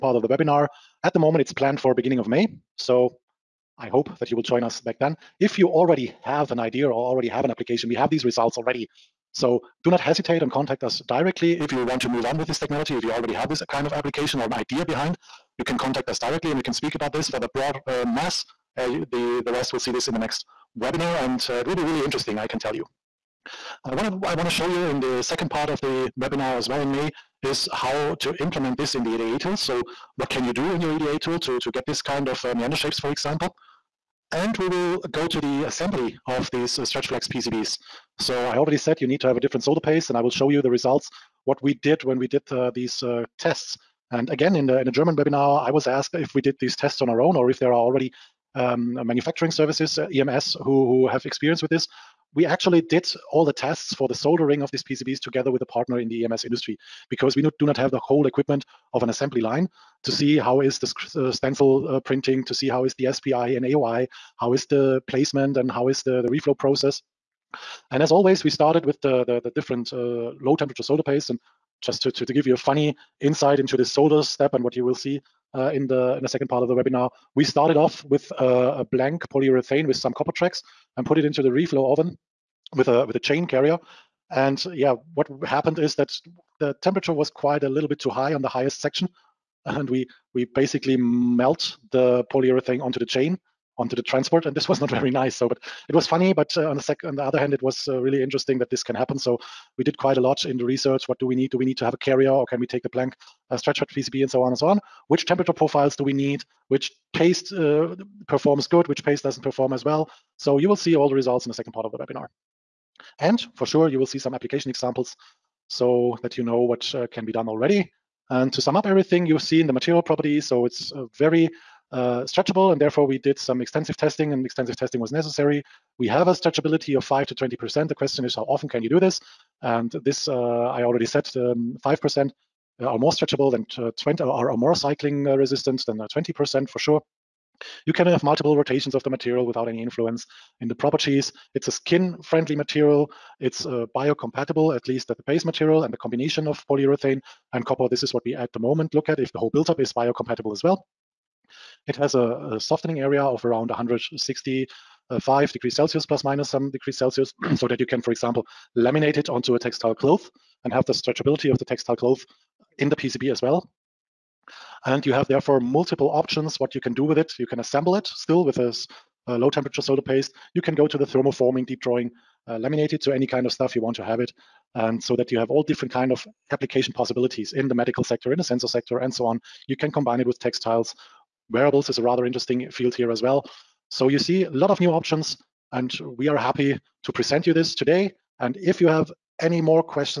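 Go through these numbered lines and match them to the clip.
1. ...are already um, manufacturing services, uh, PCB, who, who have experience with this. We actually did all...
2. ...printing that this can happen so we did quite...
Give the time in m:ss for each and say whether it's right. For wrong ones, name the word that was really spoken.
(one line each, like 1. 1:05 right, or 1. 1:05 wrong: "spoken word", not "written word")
1. 0:47 wrong: "EMS", not "PCB"
2. 1:38 wrong: "interesting", not "printing".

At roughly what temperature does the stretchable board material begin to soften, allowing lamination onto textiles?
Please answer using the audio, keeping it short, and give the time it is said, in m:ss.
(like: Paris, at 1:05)
165 degrees Celsius, at 2:33.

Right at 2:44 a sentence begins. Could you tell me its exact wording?
And you have therefore multiple options what you can do with it.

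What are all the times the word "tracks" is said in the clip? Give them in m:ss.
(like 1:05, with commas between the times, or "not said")
1:20.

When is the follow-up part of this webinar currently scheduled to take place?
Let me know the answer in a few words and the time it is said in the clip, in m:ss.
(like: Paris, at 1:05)
beginning of May, at 0:01.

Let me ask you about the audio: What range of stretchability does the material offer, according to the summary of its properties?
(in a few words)
5 to 20%.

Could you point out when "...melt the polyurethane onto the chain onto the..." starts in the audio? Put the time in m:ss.
1:30.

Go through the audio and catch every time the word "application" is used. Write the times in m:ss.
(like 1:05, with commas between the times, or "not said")
0:07, 0:13, 1:54, 2:56.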